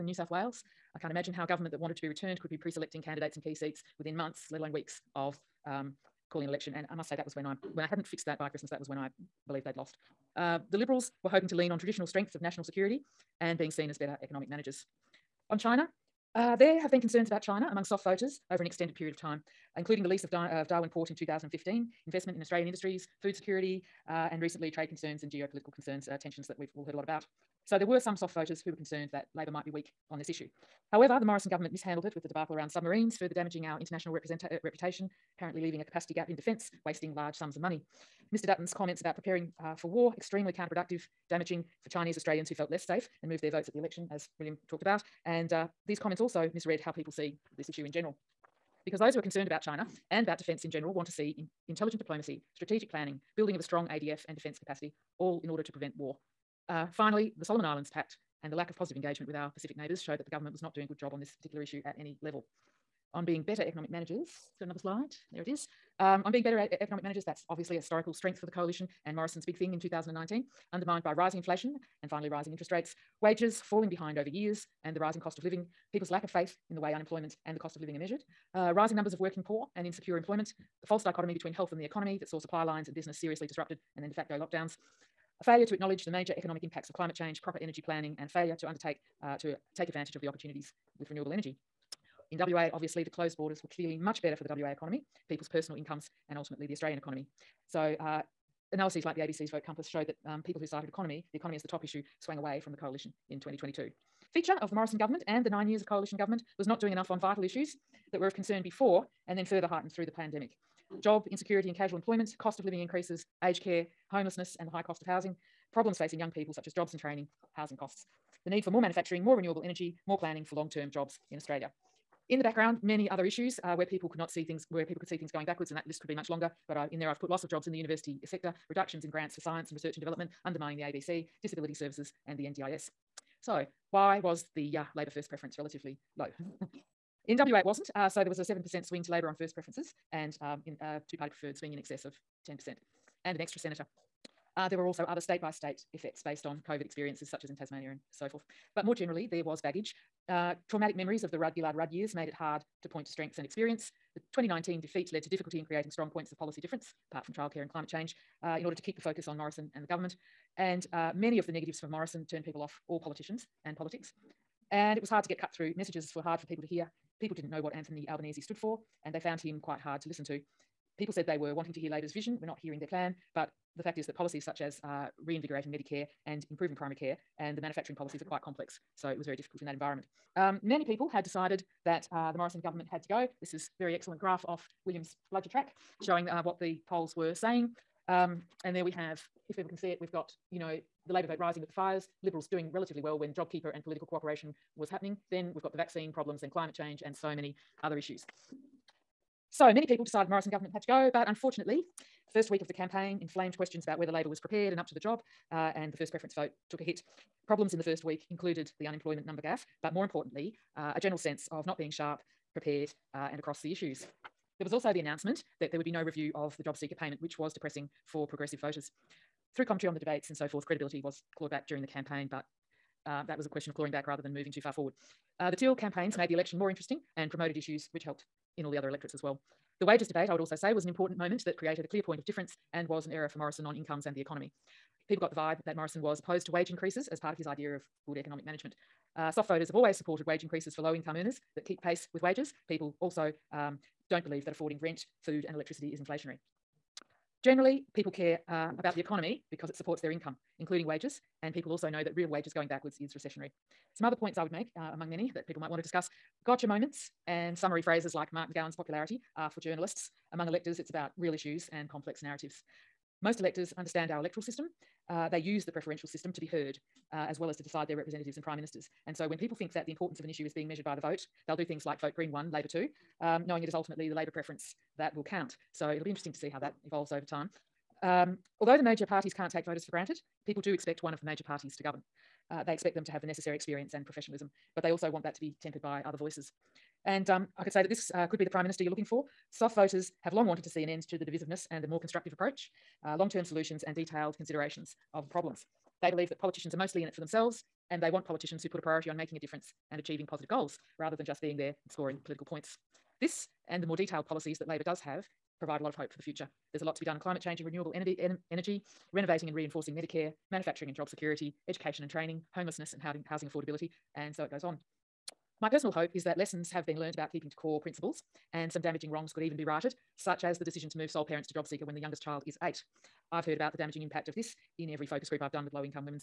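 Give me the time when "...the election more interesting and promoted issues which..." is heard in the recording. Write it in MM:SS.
03:46.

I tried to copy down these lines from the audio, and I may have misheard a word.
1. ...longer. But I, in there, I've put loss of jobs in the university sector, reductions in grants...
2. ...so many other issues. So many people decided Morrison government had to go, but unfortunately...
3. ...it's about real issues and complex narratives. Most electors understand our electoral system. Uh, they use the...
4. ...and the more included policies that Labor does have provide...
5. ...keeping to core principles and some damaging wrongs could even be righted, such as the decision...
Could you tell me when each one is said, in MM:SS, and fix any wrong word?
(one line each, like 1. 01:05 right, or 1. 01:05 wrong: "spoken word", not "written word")
1. 02:06 right
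2. 03:17 right
3. 04:20 right
4. 05:03 wrong: "detailed", not "included"
5. 05:17 right.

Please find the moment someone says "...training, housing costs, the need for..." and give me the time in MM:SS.
01:56.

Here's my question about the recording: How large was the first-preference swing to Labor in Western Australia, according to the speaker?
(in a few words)
7%.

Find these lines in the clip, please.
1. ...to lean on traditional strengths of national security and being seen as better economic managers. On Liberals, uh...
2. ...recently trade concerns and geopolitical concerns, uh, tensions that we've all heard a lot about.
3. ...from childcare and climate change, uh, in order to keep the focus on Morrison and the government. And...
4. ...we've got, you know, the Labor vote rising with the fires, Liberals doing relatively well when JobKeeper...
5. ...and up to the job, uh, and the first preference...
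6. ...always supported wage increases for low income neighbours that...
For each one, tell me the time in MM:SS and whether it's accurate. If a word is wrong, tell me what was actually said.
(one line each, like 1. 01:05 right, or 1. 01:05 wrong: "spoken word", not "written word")
1. 00:11 wrong: "China", not "Liberals"
2. 00:24 right
3. 02:37 right
4. 03:09 right
5. 03:24 right
6. 03:59 wrong: "earners", not "neighbours".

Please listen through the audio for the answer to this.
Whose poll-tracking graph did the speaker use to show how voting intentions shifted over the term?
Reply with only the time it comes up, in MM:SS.
03:04.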